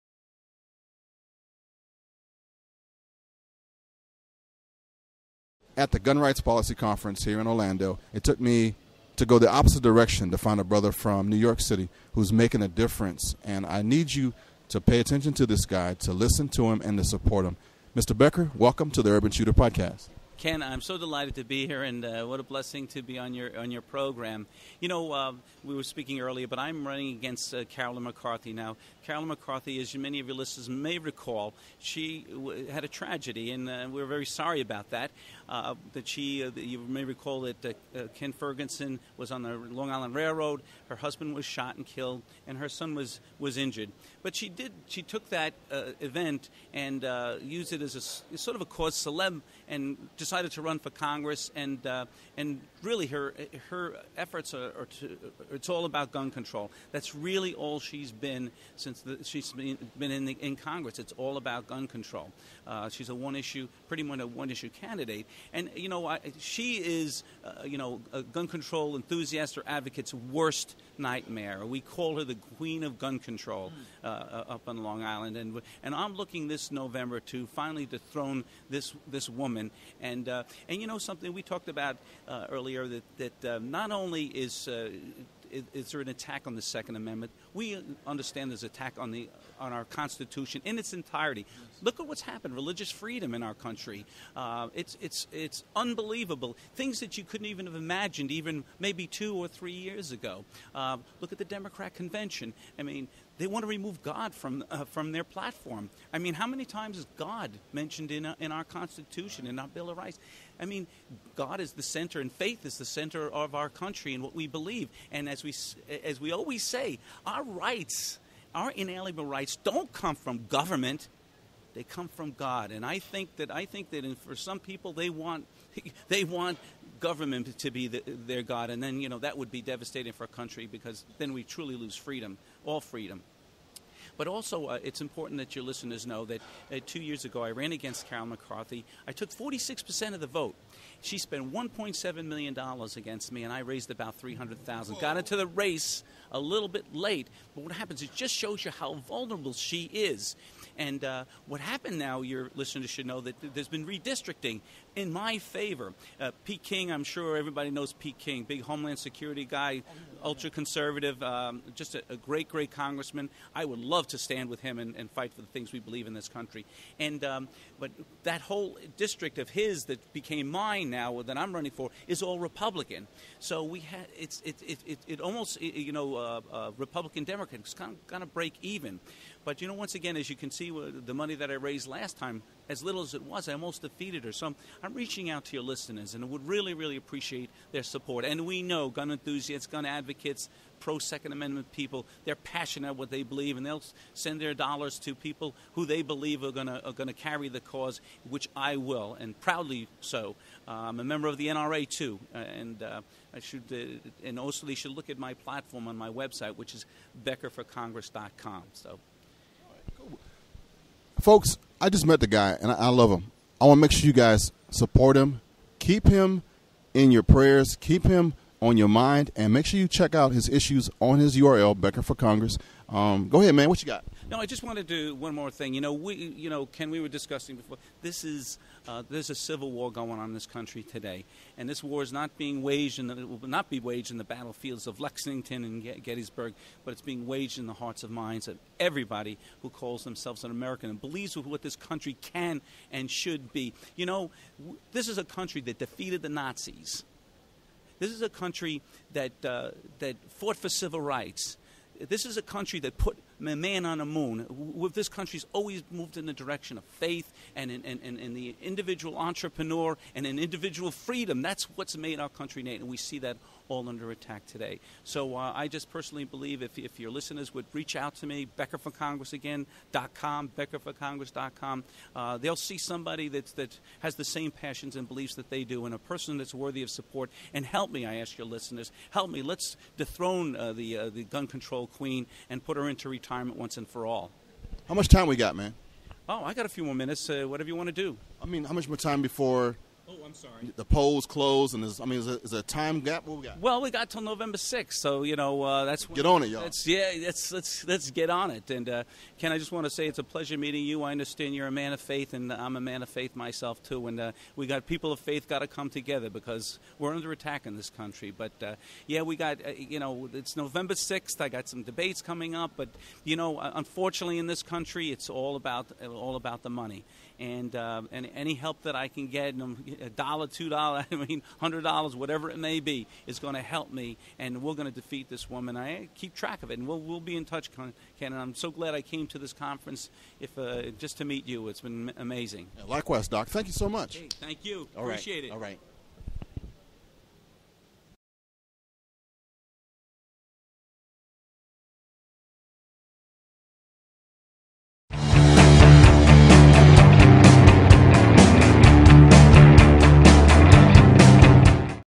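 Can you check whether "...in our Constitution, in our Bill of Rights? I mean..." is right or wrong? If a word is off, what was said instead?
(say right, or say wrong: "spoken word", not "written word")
right.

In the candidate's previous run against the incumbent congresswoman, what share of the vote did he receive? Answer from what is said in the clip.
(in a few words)
46%.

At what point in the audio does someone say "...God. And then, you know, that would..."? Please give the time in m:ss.
2:08.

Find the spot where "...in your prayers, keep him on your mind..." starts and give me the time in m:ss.
3:36.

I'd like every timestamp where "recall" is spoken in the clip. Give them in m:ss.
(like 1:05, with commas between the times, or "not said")
0:30, 0:37.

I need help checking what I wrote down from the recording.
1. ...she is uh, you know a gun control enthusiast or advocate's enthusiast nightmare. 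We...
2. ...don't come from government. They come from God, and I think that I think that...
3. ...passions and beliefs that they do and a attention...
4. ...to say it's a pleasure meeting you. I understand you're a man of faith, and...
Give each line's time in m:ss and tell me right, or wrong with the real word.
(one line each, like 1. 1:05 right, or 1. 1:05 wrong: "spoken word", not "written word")
1. 1:06 wrong: "worst", not "enthusiast"
2. 1:59 right
3. 4:34 wrong: "person", not "attention"
4. 4:59 right.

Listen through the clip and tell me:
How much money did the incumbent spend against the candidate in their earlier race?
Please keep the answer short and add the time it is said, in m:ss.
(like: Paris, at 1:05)
$1.7 million, at 2:21.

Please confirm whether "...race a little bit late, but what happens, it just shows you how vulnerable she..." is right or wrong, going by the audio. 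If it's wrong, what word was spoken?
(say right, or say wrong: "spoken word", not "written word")
right.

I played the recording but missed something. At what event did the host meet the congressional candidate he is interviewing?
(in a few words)
Gun Rights Policy Conference.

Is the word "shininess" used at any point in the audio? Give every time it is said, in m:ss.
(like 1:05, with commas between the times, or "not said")
not said.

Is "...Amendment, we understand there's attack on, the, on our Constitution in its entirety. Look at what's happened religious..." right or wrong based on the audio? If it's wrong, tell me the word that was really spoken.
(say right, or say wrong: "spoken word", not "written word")
right.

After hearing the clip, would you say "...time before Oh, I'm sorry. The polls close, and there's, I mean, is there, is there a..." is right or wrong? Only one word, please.
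right.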